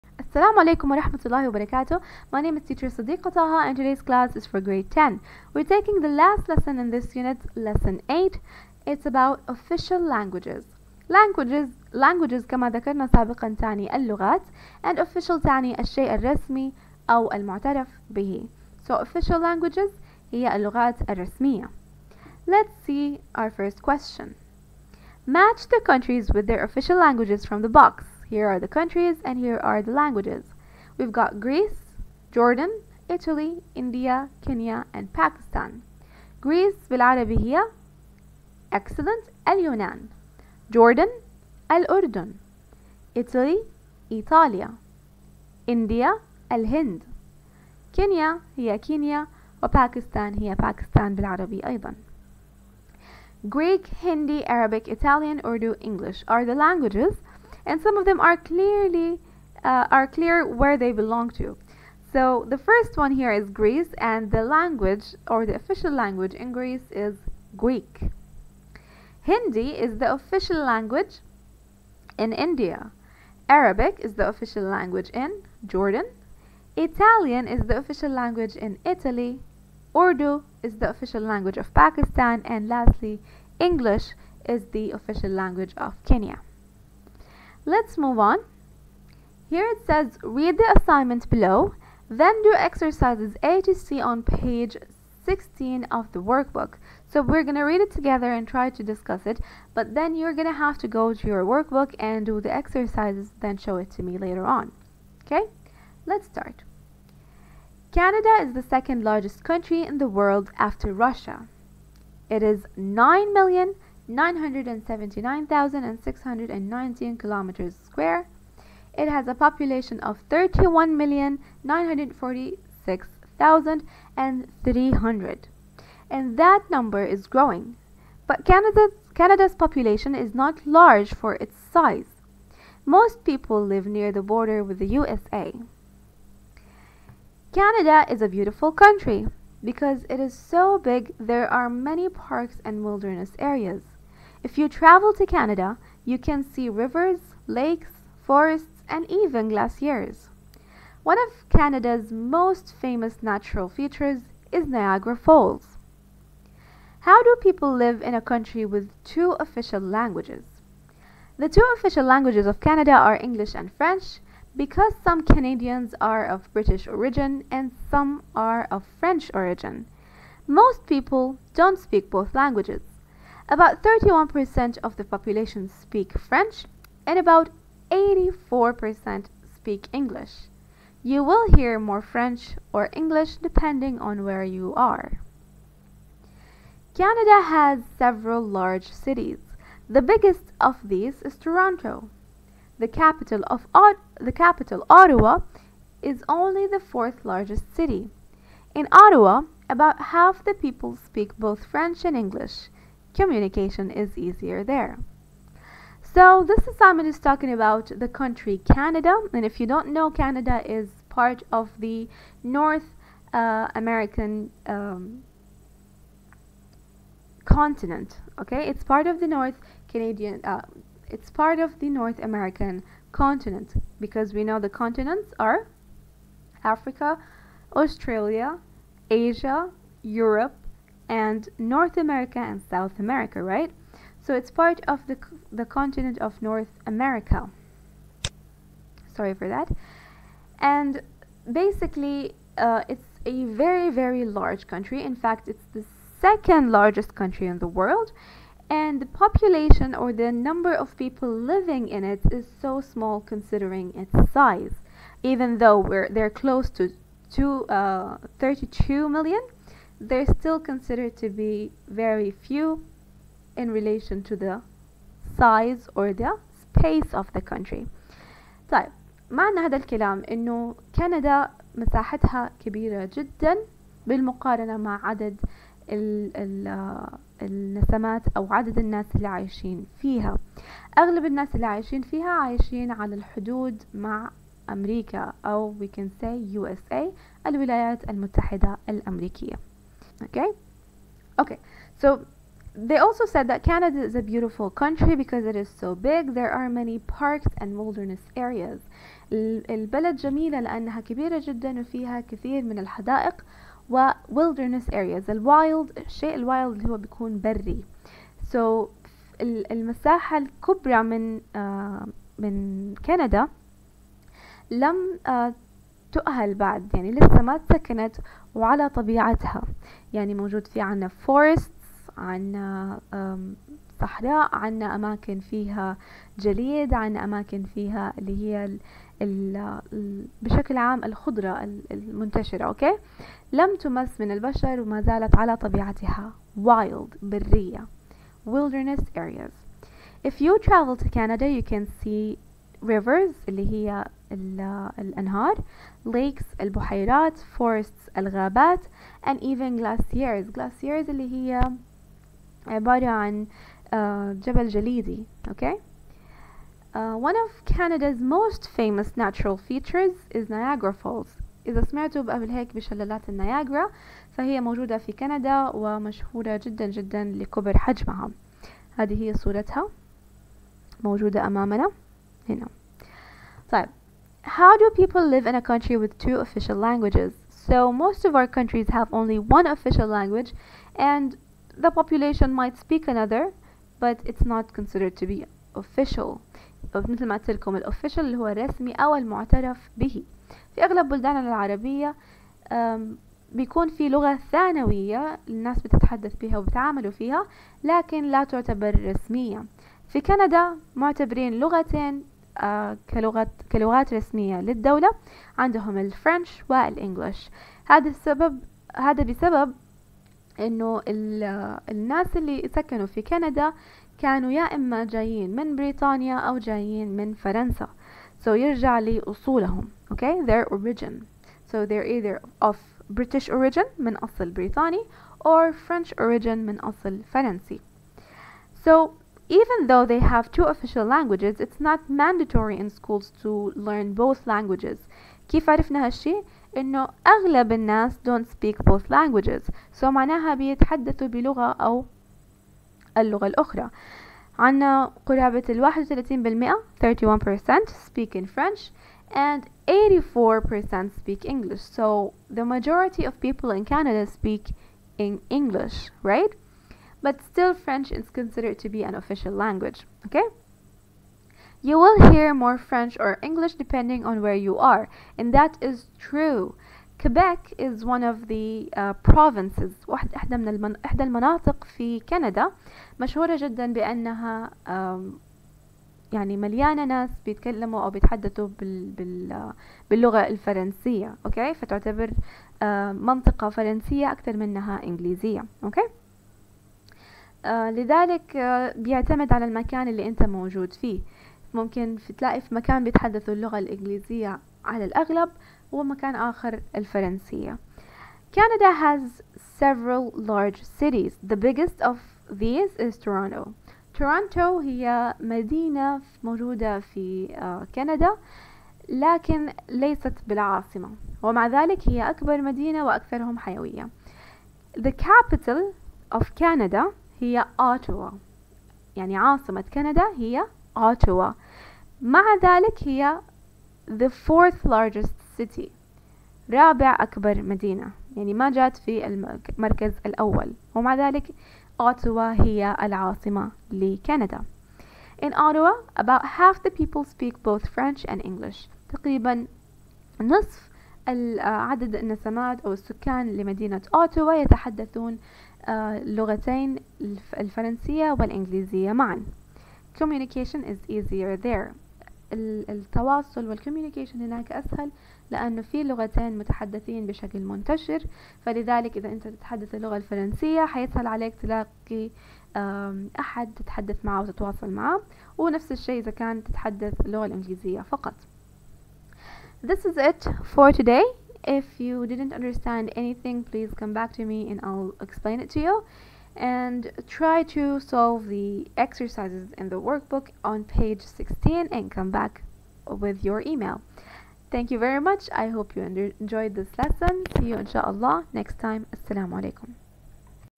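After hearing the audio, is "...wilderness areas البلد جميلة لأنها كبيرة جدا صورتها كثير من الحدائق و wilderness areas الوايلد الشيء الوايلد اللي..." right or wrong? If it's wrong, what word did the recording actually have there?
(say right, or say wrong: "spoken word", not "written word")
wrong: "وفيها", not "صورتها".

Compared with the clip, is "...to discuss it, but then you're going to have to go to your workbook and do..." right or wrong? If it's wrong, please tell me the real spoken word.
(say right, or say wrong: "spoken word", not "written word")
right.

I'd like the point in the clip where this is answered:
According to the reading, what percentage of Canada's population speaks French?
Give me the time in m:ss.
2:53.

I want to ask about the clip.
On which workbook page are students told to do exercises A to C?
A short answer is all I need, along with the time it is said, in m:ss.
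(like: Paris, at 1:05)
16, at 1:34.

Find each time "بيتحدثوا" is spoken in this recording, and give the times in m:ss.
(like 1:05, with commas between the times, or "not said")
7:20, 7:58, 8:13.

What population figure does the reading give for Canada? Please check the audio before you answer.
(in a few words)
31,946,300.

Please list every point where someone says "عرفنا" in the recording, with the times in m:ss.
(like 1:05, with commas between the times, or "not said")
7:15.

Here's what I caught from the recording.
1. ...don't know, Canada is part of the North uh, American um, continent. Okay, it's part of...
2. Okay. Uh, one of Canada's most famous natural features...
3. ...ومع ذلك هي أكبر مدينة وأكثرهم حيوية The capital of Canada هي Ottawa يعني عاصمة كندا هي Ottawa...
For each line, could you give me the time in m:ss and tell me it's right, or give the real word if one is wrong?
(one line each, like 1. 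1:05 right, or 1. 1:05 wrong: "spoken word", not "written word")
1. 3:29 right
2. 5:55 right
3. 8:31 right.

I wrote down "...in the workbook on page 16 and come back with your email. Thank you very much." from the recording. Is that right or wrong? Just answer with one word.
right.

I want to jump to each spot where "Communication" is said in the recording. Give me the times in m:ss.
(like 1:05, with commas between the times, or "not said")
3:23, 9:10.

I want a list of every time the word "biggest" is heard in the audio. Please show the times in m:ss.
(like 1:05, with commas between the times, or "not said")
3:10, 8:21.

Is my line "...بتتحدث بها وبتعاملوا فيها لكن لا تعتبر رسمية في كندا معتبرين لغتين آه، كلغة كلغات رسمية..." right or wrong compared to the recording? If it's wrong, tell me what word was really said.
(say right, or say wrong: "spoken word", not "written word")
right.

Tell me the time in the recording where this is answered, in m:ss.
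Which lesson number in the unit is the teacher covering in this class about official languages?
0:07.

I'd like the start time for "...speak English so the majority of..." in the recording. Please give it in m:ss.
7:31.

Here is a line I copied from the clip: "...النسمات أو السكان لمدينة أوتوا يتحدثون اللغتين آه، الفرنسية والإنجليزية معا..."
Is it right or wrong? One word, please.
right.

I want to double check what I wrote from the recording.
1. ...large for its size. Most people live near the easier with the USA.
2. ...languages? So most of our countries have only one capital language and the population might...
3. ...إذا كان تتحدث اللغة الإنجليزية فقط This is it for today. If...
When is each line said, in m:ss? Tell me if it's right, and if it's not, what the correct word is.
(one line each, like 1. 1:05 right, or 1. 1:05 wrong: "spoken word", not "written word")
1. 2:10 wrong: "border", not "easier"
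2. 6:16 wrong: "official", not "capital"
3. 9:26 right.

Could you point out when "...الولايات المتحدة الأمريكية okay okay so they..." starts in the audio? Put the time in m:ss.
4:47.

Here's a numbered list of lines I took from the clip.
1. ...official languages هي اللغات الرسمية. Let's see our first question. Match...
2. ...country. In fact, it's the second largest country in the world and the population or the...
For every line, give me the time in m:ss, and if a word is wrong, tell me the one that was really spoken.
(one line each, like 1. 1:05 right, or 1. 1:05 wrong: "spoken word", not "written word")
1. 0:18 right
2. 4:04 right.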